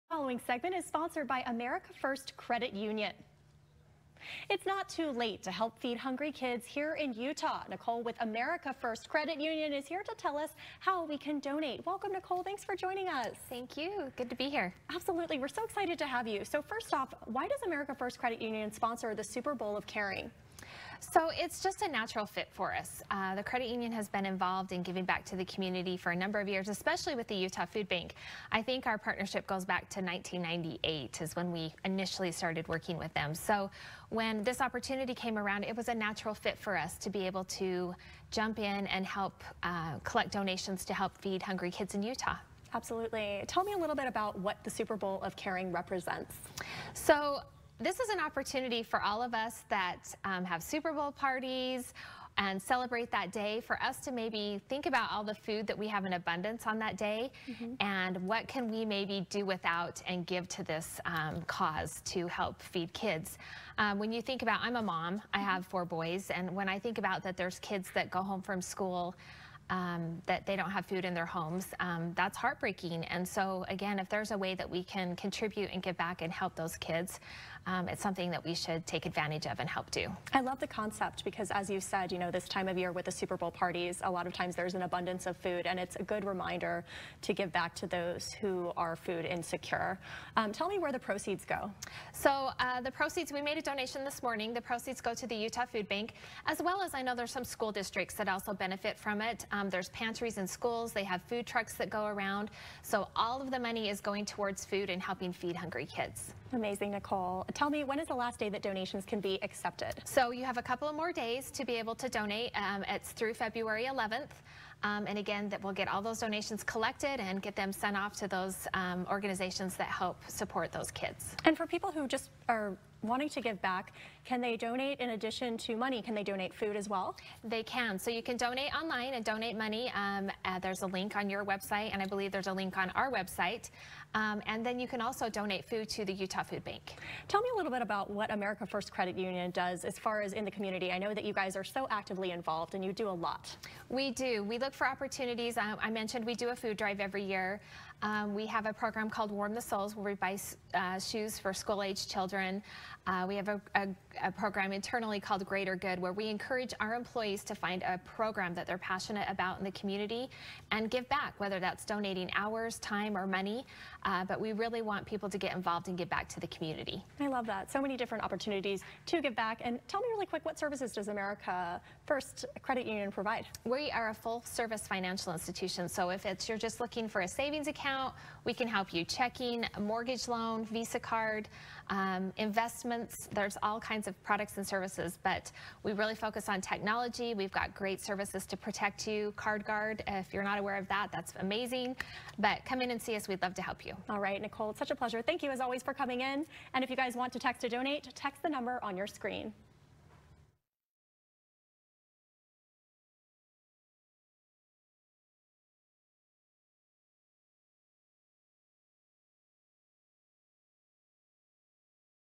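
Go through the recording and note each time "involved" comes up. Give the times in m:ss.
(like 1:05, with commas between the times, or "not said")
0:24, 2:22, 2:45.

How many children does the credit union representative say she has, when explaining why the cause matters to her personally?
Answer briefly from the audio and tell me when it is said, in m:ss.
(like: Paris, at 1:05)
4, at 1:05.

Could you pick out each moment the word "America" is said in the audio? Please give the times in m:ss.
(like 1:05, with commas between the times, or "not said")
0:01, 0:08, 0:17, 2:18, 2:51.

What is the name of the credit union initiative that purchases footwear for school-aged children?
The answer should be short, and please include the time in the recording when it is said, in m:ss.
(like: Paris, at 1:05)
Warm the Souls, at 2:29.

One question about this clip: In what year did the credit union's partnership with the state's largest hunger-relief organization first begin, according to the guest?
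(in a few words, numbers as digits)
1998.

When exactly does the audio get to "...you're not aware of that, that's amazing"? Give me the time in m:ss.
3:10.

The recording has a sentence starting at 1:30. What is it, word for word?
Um, tell me where the proceeds go.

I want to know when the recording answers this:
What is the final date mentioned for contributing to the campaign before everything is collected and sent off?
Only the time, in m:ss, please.
1:53.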